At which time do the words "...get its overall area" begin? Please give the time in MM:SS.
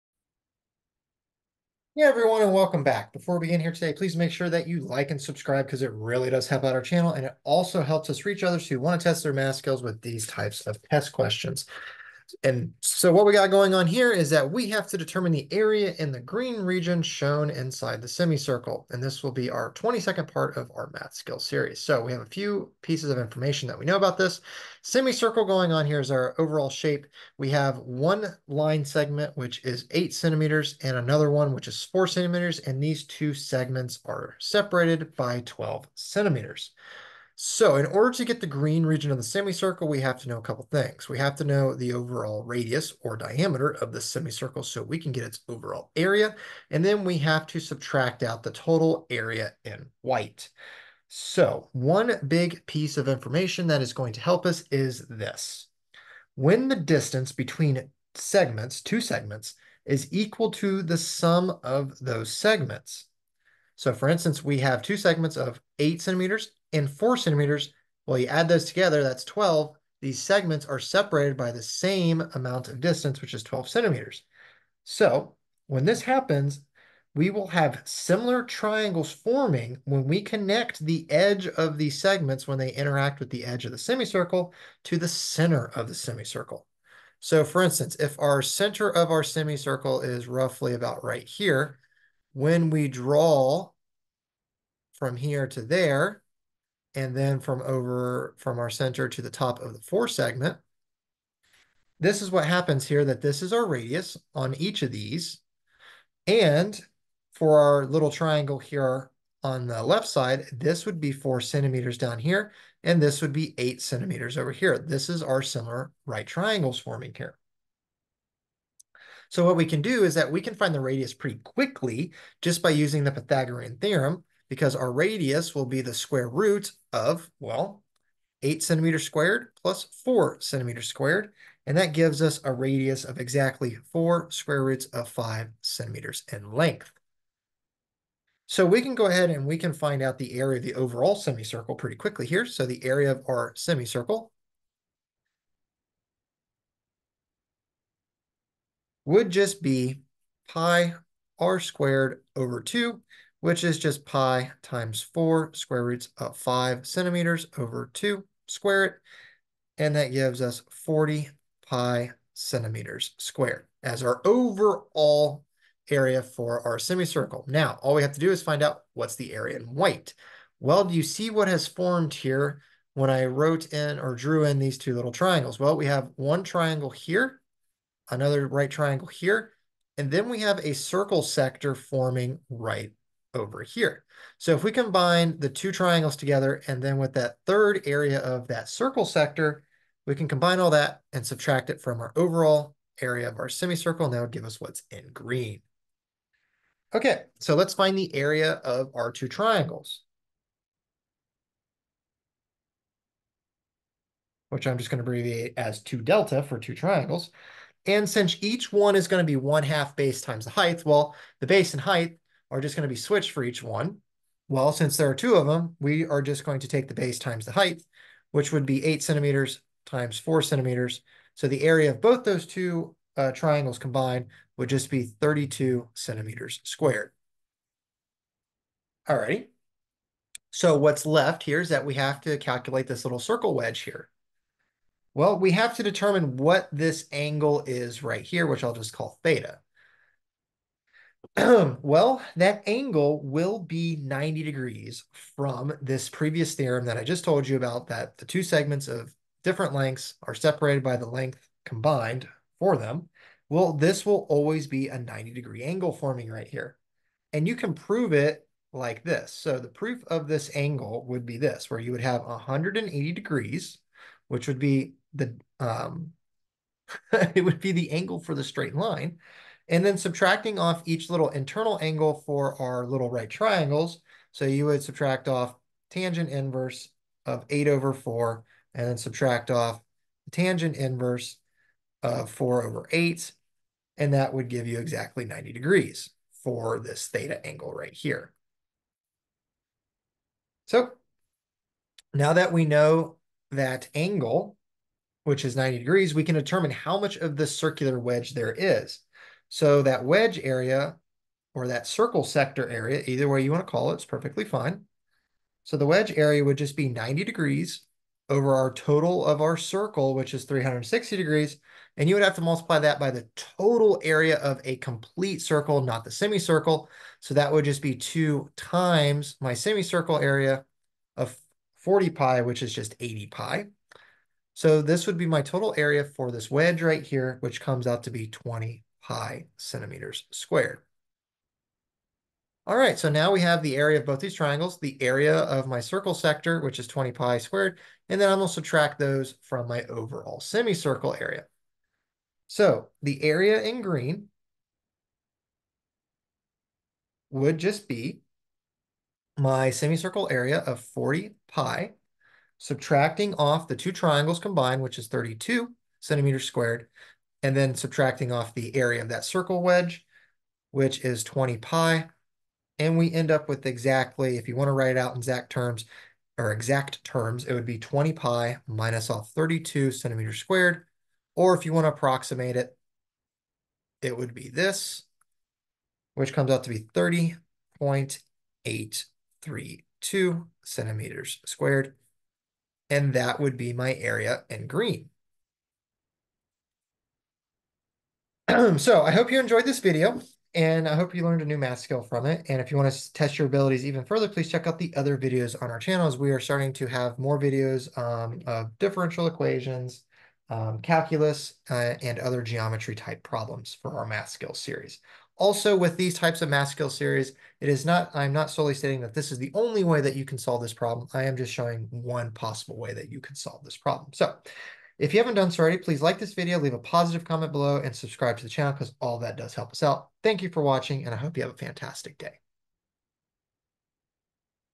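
00:45.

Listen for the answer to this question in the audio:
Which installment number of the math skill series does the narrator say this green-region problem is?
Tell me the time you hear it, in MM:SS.
00:19.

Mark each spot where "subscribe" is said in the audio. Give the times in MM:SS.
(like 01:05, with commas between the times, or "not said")
00:05, 06:57.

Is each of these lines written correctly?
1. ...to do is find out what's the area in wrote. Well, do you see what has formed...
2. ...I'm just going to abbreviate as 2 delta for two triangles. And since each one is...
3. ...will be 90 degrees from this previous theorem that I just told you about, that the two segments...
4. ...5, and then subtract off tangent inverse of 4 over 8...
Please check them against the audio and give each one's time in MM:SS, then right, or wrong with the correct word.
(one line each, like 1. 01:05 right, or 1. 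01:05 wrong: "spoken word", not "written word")
1. 02:48 wrong: "white", not "wrote"
2. 03:24 right
3. 04:03 right
4. 04:37 wrong: "4", not "5".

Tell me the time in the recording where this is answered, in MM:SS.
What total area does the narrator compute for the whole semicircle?
02:40.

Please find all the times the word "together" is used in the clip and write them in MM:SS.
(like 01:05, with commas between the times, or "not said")
01:08, 03:06.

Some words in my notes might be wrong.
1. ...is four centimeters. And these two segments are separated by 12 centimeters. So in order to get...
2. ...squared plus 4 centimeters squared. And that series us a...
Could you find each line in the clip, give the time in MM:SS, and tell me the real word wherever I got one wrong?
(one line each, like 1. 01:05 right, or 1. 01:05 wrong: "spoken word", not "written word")
1. 00:31 right
2. 02:09 wrong: "gives", not "series".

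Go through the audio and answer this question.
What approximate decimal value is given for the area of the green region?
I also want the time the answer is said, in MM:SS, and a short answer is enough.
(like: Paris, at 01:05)
30.832 cm², at 06:16.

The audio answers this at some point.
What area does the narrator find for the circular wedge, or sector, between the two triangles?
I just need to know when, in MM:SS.
05:28.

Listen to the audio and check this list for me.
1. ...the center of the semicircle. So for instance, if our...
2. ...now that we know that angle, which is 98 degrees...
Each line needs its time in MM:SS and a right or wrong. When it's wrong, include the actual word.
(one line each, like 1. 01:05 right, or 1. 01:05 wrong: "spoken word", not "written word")
1. 01:24 right
2. 04:52 wrong: "90", not "98".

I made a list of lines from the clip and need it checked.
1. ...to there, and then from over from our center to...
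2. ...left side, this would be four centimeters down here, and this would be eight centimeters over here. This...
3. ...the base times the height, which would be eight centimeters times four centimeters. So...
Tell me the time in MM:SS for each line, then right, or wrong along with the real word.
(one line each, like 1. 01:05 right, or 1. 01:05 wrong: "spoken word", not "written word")
1. 01:35 right
2. 01:49 right
3. 03:36 right.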